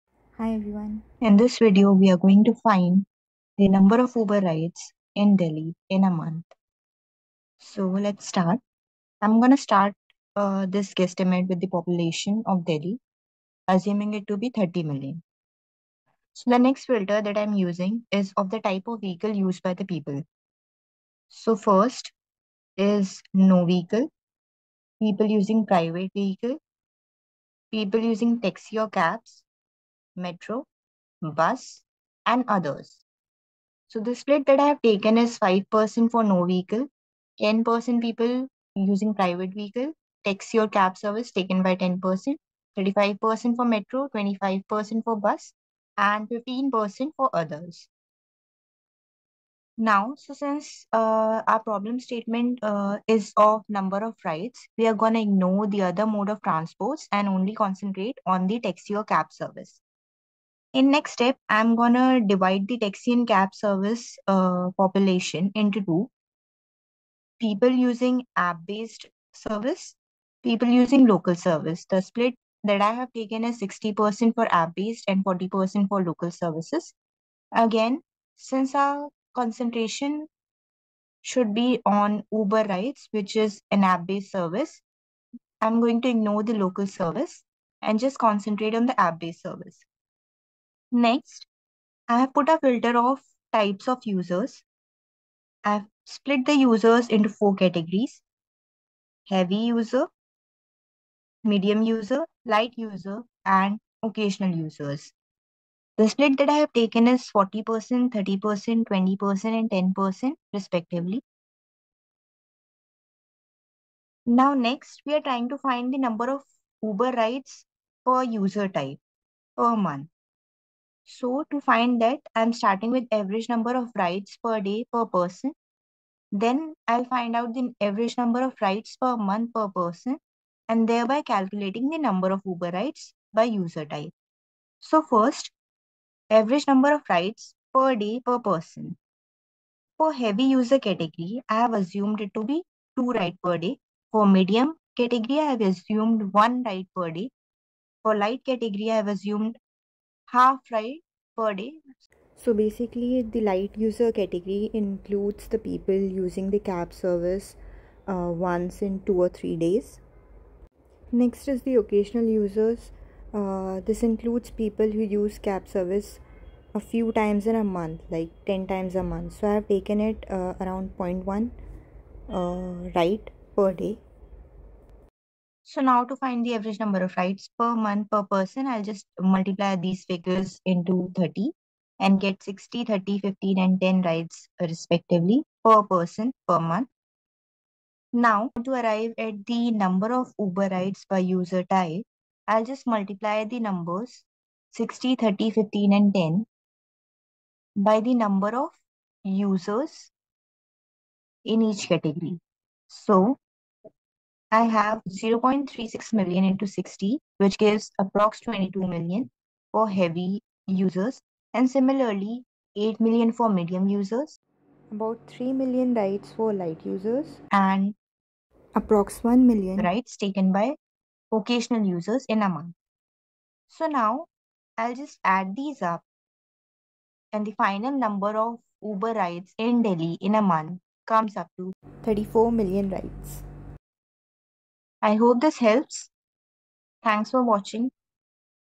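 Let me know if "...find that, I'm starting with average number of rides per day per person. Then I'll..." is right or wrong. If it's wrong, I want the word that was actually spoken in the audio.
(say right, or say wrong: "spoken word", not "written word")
right.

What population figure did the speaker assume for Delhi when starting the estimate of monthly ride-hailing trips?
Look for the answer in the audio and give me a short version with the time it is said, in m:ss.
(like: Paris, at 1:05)
30 million, at 0:14.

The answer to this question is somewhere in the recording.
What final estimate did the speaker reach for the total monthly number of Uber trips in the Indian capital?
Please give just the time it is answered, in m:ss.
3:52.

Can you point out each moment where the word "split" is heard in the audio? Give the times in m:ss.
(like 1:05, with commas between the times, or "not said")
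0:34, 1:12, 1:36, 1:46.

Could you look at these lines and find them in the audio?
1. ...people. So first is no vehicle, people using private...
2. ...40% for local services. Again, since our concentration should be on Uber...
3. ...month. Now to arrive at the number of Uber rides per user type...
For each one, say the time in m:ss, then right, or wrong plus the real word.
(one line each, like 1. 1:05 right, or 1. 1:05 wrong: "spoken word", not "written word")
1. 0:19 right
2. 1:15 right
3. 3:06 right.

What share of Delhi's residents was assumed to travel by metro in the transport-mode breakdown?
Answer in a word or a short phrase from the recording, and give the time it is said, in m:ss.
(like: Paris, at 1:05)
35%, at 0:42.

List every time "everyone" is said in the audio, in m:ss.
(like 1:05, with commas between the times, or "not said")
0:00.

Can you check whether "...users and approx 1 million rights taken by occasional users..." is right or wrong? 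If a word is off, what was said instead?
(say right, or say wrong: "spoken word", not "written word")
right.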